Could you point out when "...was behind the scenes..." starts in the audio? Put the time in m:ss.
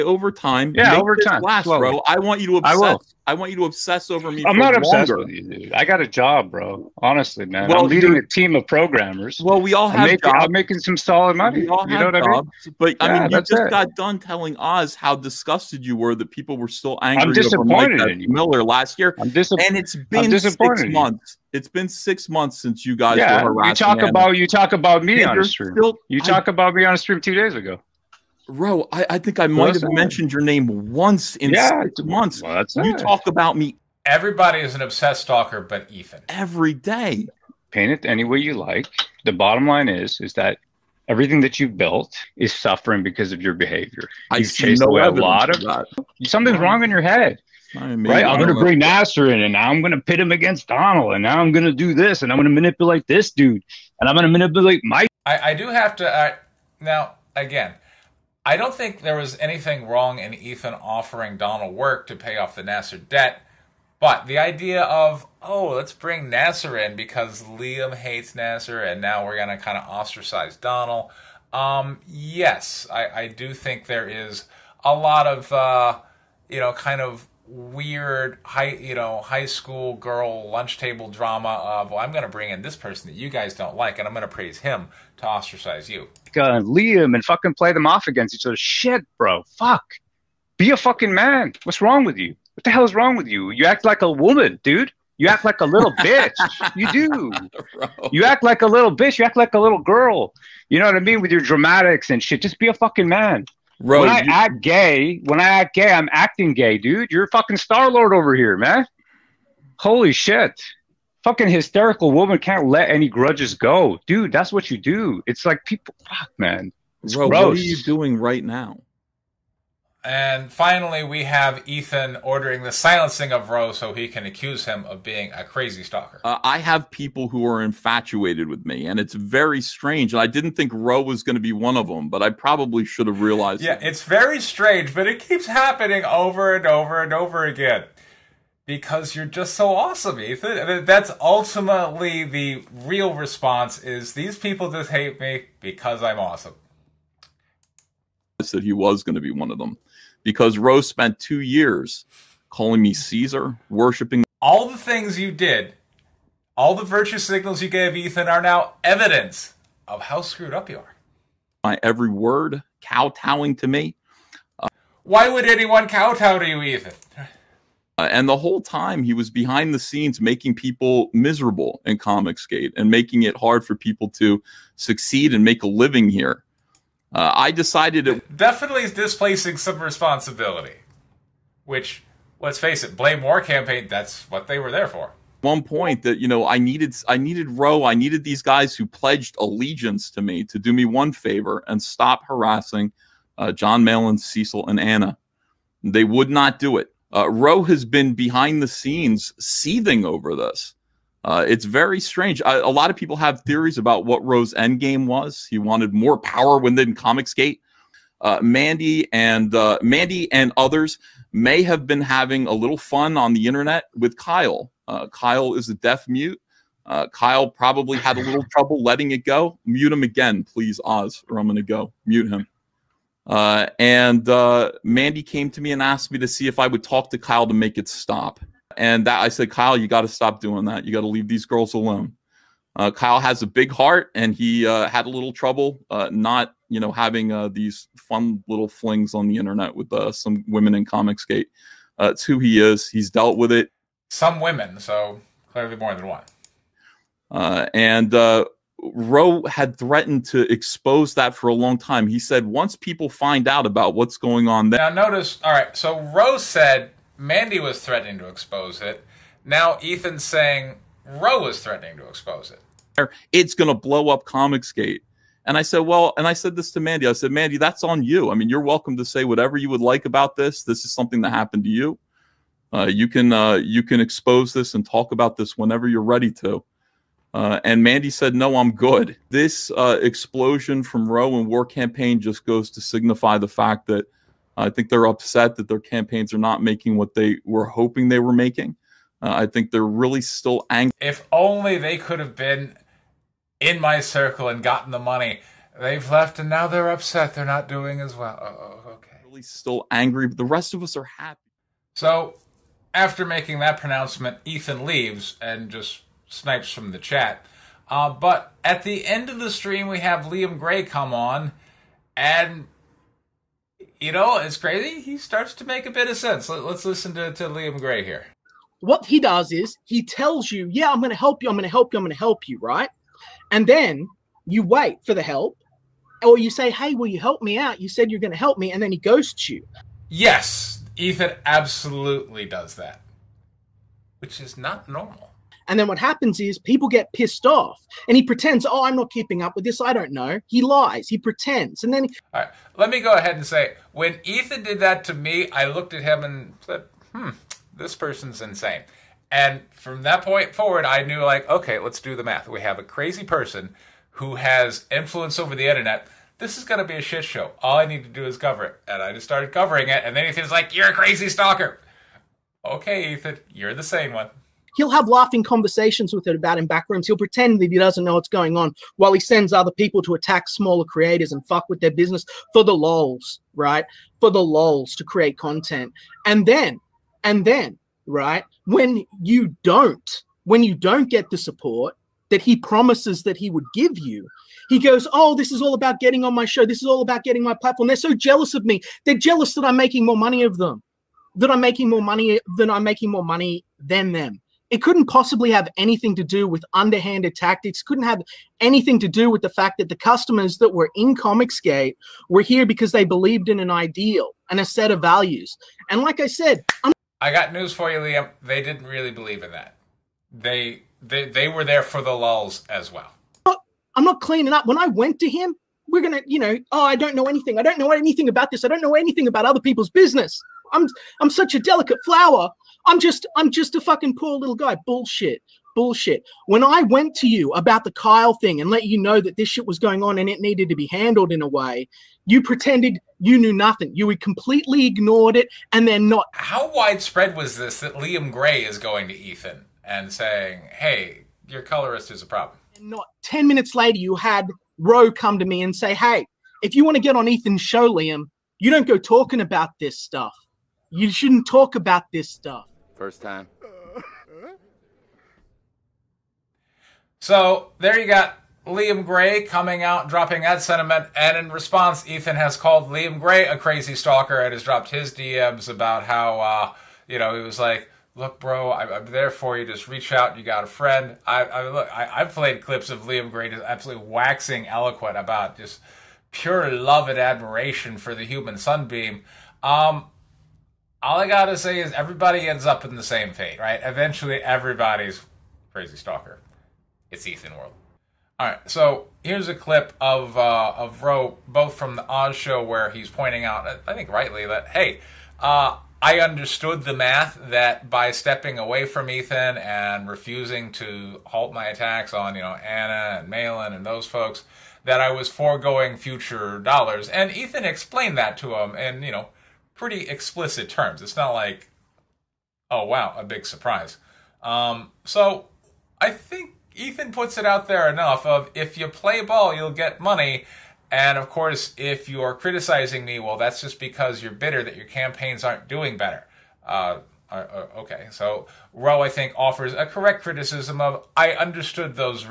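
2:49.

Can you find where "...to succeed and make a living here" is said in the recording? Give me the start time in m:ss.
2:54.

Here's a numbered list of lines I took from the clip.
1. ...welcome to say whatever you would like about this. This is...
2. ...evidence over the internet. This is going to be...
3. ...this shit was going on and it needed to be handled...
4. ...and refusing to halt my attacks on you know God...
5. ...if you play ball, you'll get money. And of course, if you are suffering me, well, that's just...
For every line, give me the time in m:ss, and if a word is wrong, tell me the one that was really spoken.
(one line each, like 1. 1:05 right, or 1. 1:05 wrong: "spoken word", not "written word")
1. 4:28 right
2. 5:54 wrong: "influence", not "evidence"
3. 7:09 right
4. 8:19 wrong: "Anna", not "God"
5. 8:38 wrong: "criticizing", not "suffering".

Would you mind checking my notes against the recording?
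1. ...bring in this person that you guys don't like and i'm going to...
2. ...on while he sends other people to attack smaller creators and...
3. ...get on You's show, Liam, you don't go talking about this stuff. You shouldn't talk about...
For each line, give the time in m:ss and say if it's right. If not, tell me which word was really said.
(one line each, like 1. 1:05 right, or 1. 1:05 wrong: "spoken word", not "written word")
1. 1:22 right
2. 6:08 right
3. 7:27 wrong: "Ethan", not "You".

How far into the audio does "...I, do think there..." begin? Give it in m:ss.
1:13.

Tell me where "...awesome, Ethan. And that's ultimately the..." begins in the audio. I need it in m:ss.
2:19.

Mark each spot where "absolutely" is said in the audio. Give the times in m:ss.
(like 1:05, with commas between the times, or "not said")
5:31, 7:53.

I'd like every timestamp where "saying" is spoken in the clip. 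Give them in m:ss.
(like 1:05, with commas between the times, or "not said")
4:20, 7:20.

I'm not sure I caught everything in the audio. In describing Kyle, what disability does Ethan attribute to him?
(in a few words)
deaf mute.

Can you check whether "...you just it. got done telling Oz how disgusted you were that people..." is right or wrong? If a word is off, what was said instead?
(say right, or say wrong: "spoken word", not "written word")
right.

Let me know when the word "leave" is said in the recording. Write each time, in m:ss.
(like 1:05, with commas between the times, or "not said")
3:51, 5:04.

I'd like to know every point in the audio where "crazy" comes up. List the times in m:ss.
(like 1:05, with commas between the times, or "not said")
2:05, 5:14, 5:52, 6:00, 7:43, 8:05.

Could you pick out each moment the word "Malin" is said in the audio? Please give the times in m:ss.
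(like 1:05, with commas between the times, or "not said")
3:13, 8:23.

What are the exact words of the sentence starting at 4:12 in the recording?
He said once people find out about what's going on there.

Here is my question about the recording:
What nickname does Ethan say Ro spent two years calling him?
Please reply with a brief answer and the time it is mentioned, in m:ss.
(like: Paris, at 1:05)
Caesar, at 2:32.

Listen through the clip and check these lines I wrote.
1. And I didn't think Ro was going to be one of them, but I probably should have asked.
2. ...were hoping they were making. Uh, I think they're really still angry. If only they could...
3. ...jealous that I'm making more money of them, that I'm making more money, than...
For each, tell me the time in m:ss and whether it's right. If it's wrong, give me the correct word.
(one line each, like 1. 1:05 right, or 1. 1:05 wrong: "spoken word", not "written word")
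1. 2:10 wrong: "realized", not "asked"
2. 4:47 right
3. 6:29 right.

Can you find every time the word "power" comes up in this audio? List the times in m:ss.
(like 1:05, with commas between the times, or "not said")
3:26.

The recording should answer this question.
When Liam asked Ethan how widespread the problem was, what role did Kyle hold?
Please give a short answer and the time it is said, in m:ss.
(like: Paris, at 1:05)
colorist, at 7:21.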